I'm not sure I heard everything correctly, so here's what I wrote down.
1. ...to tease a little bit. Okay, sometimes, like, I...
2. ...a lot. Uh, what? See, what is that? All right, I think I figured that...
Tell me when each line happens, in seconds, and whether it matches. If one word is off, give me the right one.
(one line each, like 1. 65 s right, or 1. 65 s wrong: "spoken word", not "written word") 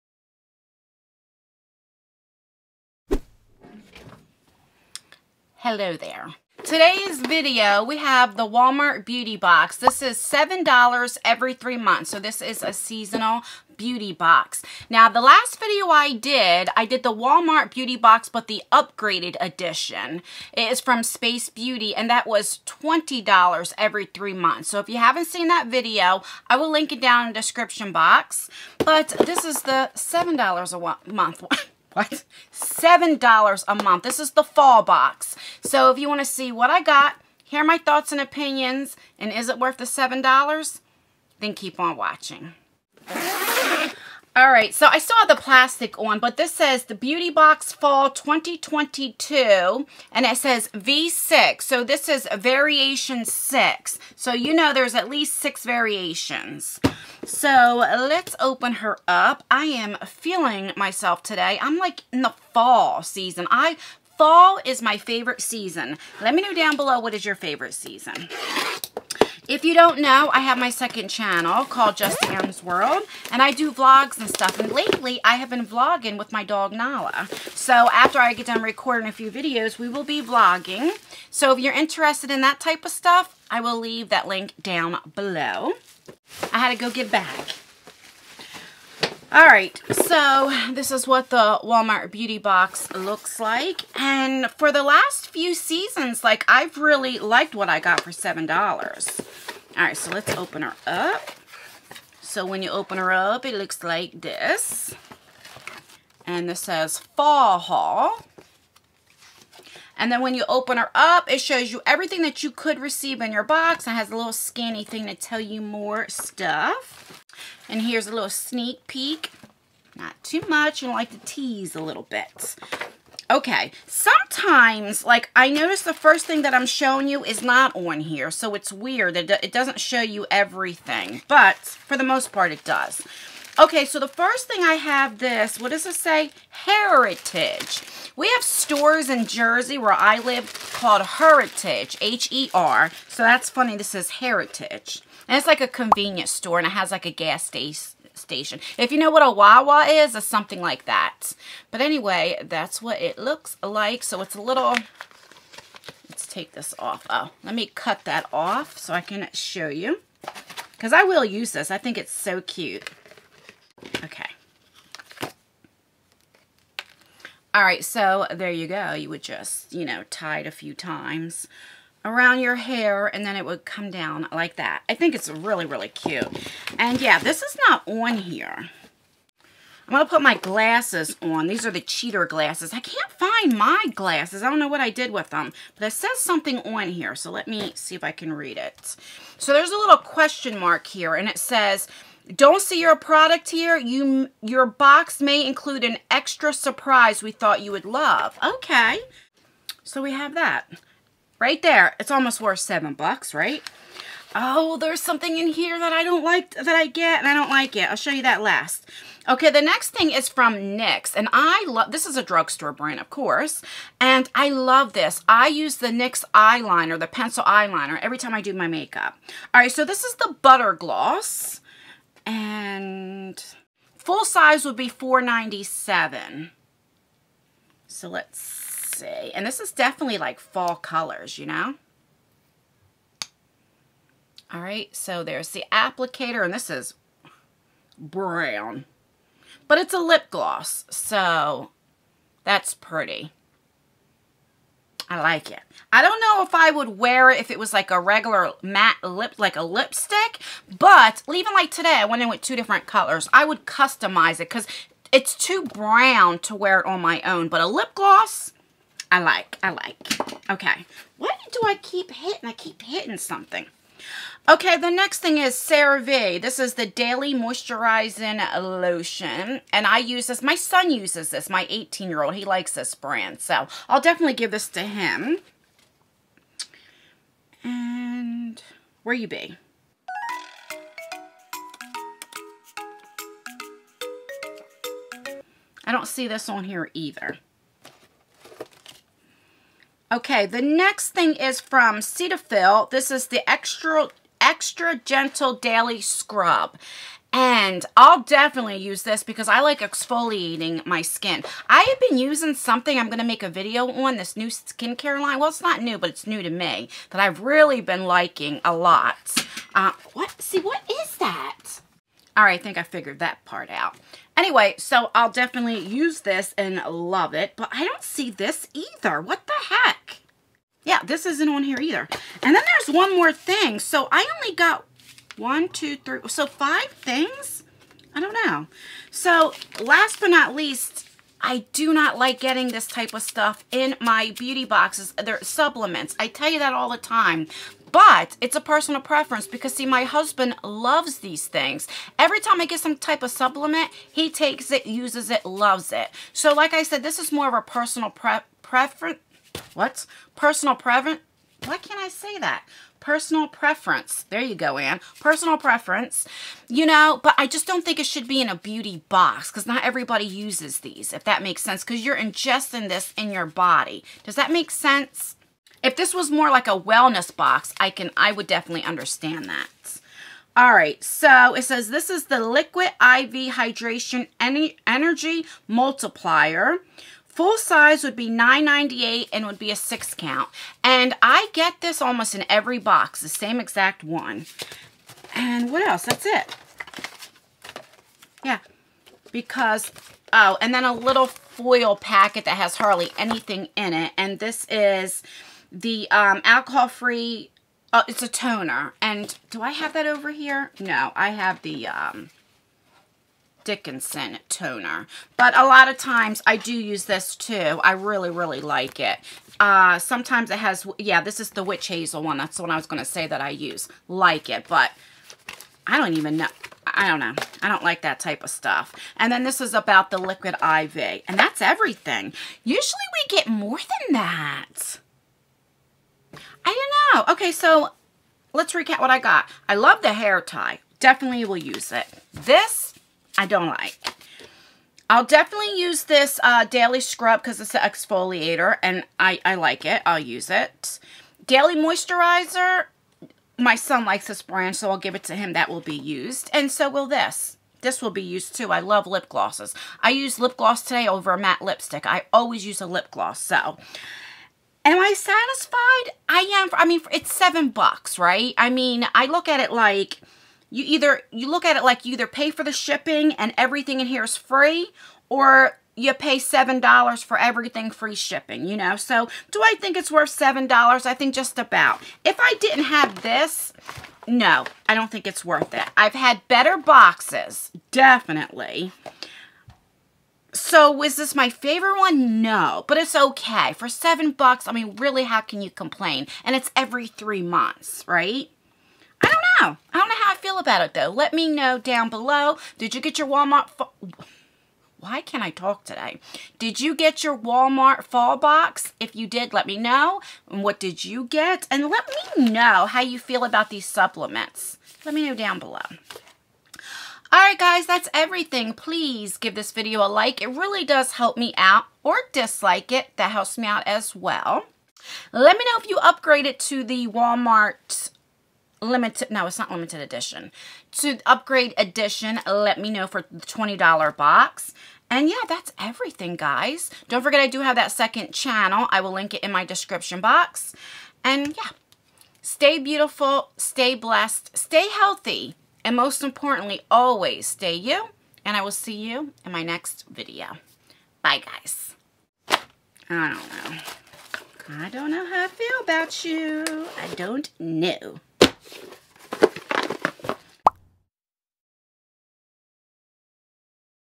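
1. 121 s right
2. 308 s right.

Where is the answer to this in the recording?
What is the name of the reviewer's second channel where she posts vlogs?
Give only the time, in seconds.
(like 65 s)
71 s.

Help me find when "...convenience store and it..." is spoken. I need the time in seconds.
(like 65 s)
145 s.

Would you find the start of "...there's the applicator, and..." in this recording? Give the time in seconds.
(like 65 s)
235 s.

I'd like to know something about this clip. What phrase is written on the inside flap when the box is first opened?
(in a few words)
Fall Haul.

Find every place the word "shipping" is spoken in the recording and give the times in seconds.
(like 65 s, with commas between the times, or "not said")
462 s, 468 s.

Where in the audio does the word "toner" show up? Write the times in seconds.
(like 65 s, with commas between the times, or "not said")
398 s, 404 s.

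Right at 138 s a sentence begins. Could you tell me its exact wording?
We have stores in Jersey where I live called Heritage, H-E-R.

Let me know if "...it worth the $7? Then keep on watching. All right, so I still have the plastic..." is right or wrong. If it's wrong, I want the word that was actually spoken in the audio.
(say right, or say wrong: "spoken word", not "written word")
right.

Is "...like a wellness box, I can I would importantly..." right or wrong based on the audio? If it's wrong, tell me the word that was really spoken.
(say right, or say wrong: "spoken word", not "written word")
wrong: "definitely", not "importantly".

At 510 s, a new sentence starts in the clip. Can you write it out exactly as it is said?
It really does help me out or dislike it.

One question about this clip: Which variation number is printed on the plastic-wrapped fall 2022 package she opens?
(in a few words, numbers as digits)
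V6.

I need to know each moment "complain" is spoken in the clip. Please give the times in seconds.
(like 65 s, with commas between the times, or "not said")
485 s.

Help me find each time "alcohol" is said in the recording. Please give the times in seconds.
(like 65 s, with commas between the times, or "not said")
396 s.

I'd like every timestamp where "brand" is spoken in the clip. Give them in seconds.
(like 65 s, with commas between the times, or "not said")
212 s, 272 s, 444 s.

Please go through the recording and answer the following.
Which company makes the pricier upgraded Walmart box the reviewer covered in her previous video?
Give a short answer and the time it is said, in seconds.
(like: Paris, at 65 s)
Space Beauty, at 21 s.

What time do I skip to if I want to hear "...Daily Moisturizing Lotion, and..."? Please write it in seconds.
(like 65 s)
266 s.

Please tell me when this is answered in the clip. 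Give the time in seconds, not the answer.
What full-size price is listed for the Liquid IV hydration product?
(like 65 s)
378 s.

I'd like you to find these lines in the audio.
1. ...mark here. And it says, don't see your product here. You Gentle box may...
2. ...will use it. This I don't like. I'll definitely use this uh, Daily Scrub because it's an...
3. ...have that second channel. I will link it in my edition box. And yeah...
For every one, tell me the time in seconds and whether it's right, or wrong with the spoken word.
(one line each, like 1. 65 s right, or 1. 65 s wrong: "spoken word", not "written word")
1. 190 s wrong: "Your", not "Gentle"
2. 431 s right
3. 527 s wrong: "description", not "edition".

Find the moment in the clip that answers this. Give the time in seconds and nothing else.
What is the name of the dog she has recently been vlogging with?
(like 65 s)
76 s.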